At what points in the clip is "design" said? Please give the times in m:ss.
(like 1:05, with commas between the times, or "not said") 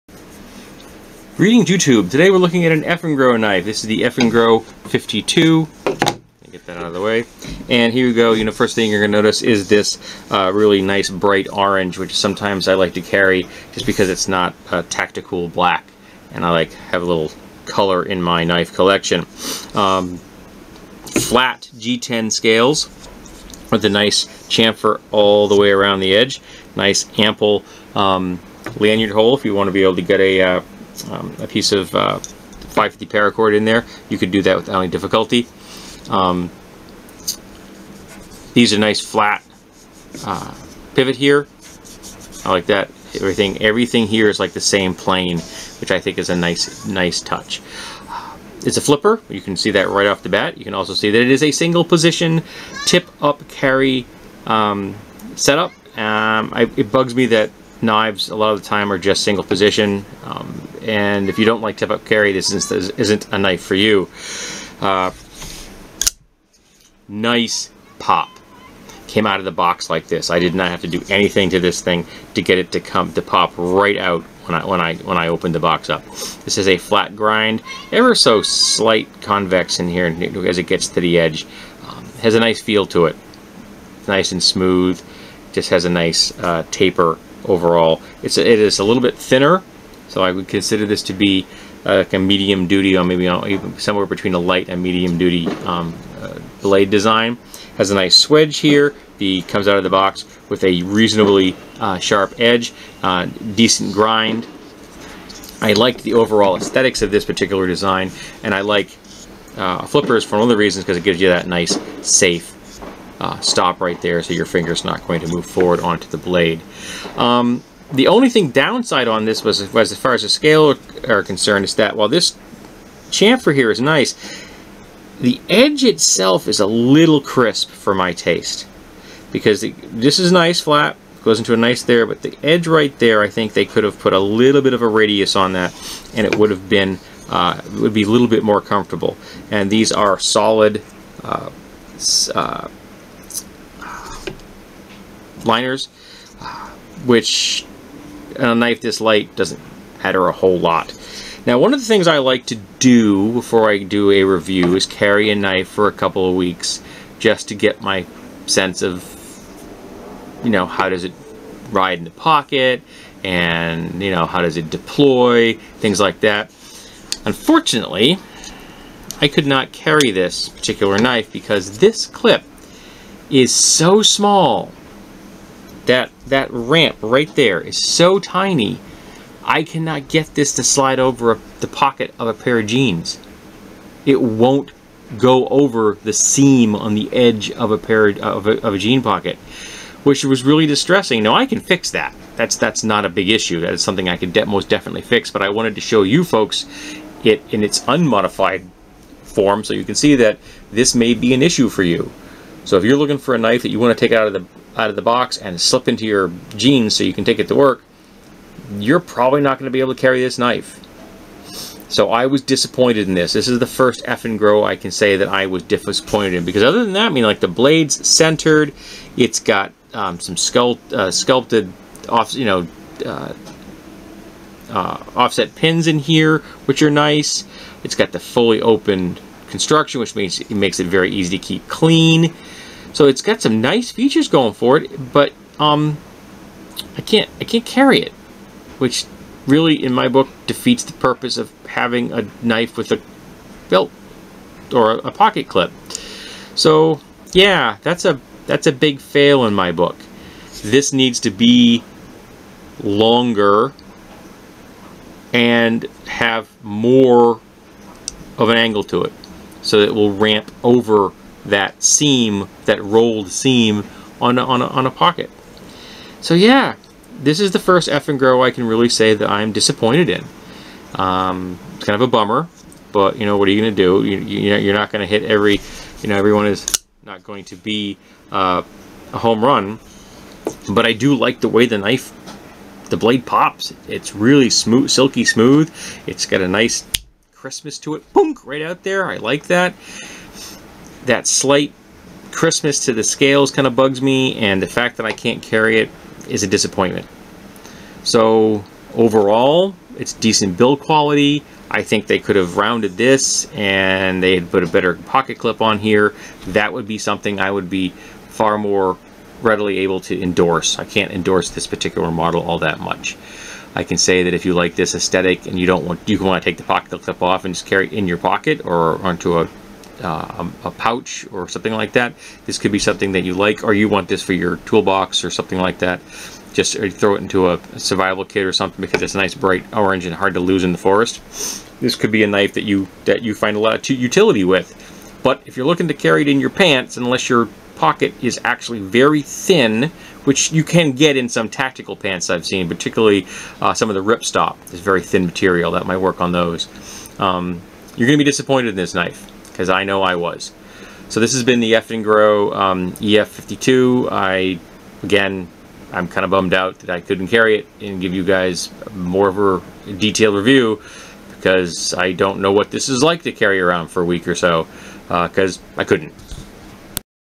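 1:36, 1:47.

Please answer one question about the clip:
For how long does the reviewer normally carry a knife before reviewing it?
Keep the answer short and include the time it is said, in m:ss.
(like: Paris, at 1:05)
a couple of weeks, at 2:35.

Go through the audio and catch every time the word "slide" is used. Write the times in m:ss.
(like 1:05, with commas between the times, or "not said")
3:00.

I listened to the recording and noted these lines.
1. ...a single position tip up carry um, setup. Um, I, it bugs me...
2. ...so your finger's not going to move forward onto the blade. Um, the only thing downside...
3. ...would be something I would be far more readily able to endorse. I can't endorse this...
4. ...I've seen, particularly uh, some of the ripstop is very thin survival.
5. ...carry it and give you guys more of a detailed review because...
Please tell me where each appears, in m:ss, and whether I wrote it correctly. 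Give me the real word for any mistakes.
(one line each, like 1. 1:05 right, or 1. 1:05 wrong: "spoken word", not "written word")
1. 0:51 right
2. 1:54 right
3. 5:06 right
4. 5:42 wrong: "material", not "survival"
5. 5:57 right.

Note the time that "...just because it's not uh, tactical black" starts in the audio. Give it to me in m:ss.
0:13.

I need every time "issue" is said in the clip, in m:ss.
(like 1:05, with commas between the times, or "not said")
3:13, 3:21.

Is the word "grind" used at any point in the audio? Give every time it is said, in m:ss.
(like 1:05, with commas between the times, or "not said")
1:17, 1:43.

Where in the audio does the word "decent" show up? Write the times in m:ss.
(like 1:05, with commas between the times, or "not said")
1:43, 5:00.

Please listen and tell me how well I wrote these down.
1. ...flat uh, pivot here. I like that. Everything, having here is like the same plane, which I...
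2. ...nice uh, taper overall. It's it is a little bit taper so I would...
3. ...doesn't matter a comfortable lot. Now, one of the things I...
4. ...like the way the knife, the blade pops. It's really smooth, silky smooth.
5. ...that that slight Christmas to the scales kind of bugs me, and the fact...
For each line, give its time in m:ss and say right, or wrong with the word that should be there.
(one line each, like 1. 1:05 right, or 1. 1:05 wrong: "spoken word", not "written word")
1. 0:38 wrong: "everything", not "having"
2. 1:25 wrong: "thinner", not "taper"
3. 2:29 wrong: "whole", not "comfortable"
4. 4:41 right
5. 4:49 right.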